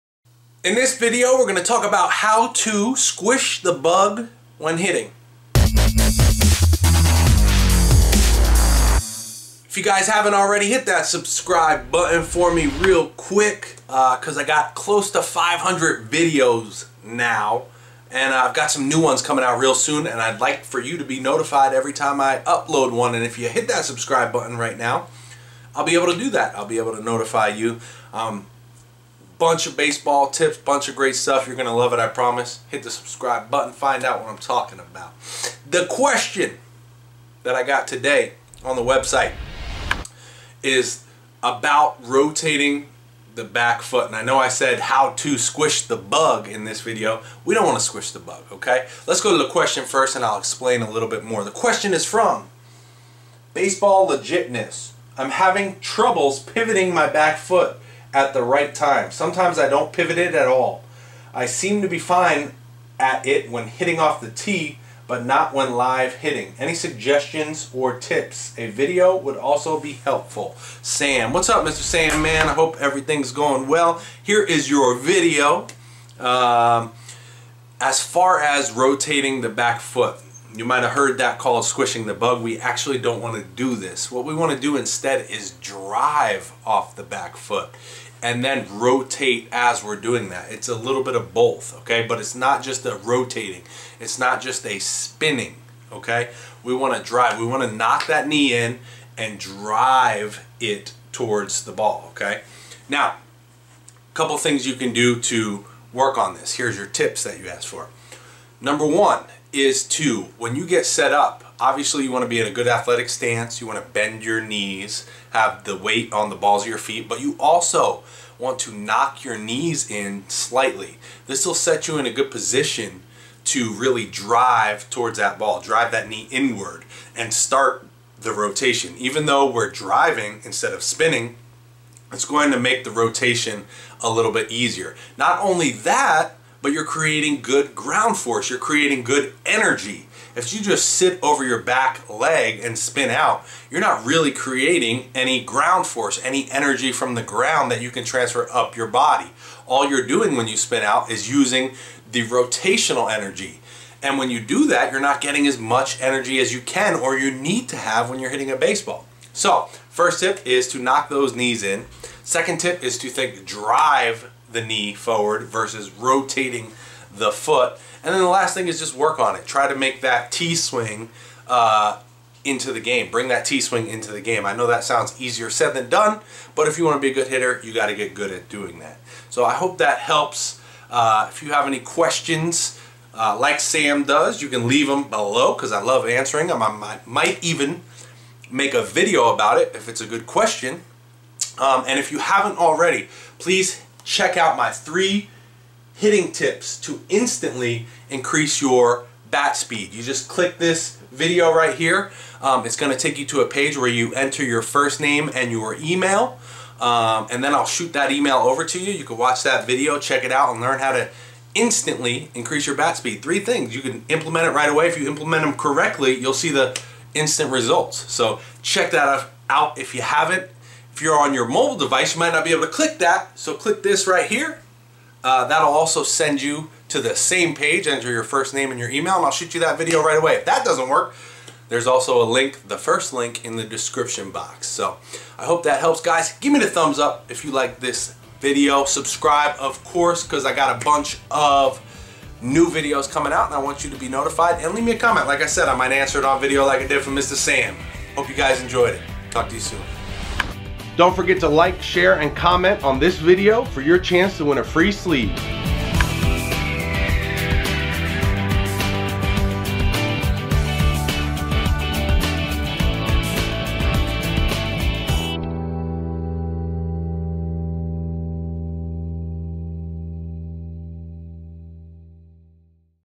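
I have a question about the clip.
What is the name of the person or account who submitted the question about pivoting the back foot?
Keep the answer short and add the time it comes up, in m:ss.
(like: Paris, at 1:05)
Baseball Legitness, at 0:53.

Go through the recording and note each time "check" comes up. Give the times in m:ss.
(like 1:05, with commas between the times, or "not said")
3:14, 3:29, 3:38.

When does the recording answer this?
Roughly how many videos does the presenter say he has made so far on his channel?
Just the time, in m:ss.
0:15.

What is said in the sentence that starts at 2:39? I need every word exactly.
So, first tip is to knock those knees in.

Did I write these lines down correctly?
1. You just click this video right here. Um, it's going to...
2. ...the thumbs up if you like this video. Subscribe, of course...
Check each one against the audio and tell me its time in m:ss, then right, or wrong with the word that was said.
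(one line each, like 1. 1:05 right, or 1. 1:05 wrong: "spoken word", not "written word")
1. 3:19 right
2. 3:56 right.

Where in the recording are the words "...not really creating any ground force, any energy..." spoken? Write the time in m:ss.
2:23.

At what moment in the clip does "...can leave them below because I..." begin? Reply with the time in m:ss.
3:04.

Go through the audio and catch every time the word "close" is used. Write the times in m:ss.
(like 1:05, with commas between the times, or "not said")
0:14.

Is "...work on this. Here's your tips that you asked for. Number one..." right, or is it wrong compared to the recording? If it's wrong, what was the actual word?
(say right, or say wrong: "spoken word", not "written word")
right.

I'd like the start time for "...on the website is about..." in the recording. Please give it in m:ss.
0:38.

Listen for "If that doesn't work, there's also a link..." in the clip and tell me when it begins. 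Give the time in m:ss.
3:50.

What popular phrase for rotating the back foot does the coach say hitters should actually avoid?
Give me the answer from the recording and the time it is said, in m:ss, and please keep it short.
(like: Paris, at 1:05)
Squishing the bug, at 1:21.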